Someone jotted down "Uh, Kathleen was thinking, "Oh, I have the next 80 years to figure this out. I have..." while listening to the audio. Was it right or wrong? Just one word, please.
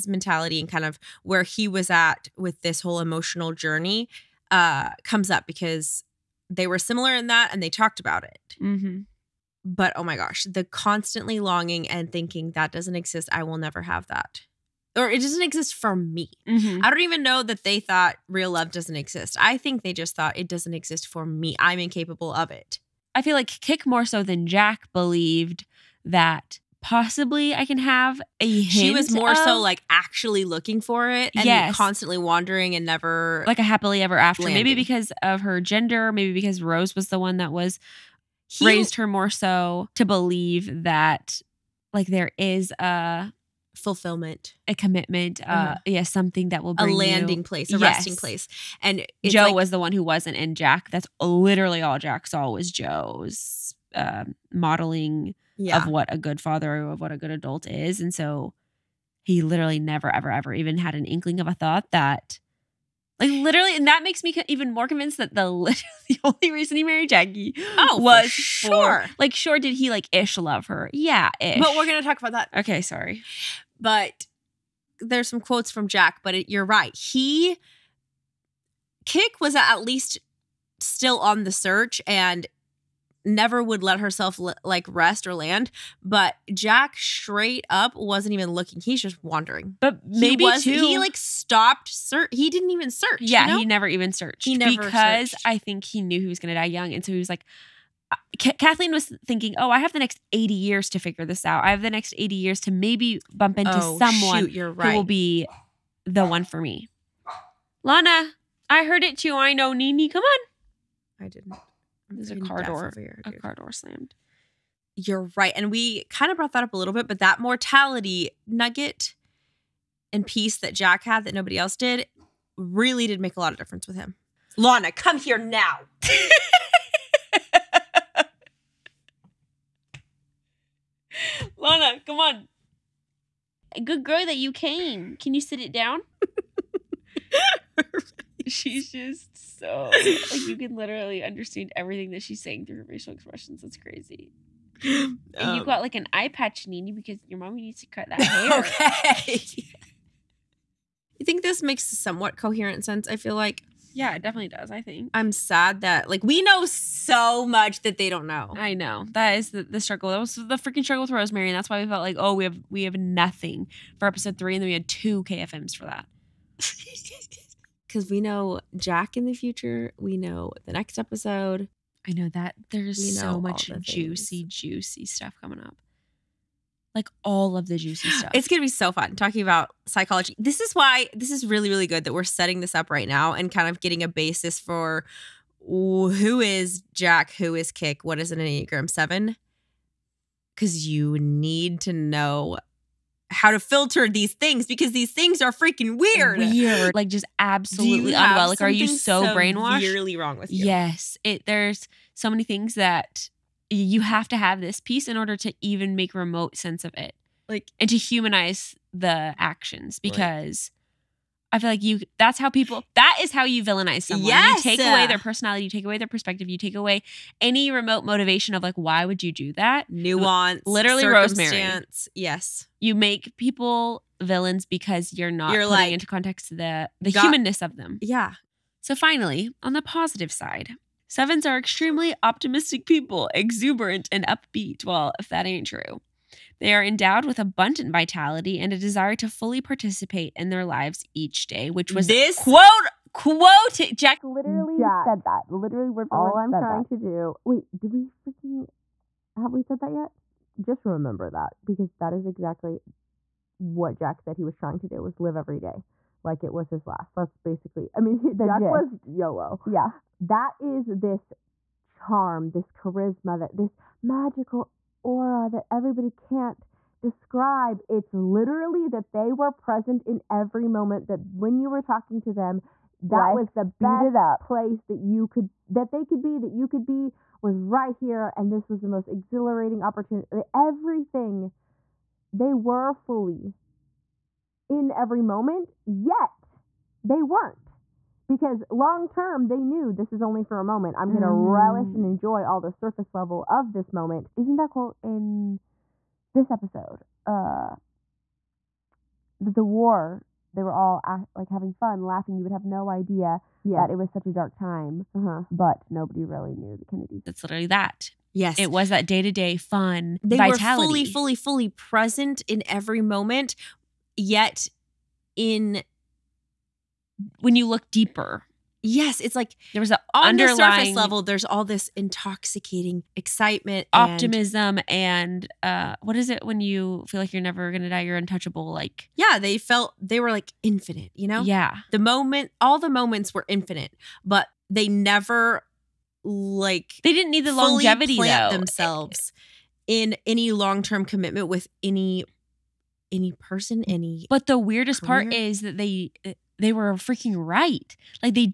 right.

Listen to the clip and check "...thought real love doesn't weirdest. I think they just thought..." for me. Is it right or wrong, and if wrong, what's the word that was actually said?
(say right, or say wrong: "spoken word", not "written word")
wrong: "exist", not "weirdest".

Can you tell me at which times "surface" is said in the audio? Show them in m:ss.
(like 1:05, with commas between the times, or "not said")
4:52, 5:20.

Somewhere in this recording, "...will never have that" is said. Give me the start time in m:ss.
0:13.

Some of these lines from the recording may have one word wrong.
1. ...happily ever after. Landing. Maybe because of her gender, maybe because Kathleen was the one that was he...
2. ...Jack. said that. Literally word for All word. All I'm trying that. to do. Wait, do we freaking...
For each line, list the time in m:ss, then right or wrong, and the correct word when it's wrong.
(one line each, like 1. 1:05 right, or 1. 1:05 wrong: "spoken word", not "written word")
1. 0:33 wrong: "Rose", not "Kathleen"
2. 4:04 right.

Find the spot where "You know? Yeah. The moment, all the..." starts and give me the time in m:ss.
5:31.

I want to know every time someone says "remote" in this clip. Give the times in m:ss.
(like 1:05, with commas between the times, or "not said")
3:26, 3:37.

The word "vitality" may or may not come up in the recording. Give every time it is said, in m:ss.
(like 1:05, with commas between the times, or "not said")
3:57, 5:10.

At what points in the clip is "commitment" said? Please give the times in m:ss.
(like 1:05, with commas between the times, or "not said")
0:44, 5:41.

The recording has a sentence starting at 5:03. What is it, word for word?
that it was such a dark time, uh -huh.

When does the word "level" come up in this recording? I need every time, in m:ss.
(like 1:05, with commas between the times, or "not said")
4:53, 5:20.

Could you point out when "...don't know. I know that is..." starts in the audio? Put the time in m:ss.
2:38.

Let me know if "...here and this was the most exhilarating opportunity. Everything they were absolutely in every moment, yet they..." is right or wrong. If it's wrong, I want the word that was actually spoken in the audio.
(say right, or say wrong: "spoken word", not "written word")
wrong: "fully", not "absolutely".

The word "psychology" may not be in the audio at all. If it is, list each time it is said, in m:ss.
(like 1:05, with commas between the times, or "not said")
2:59.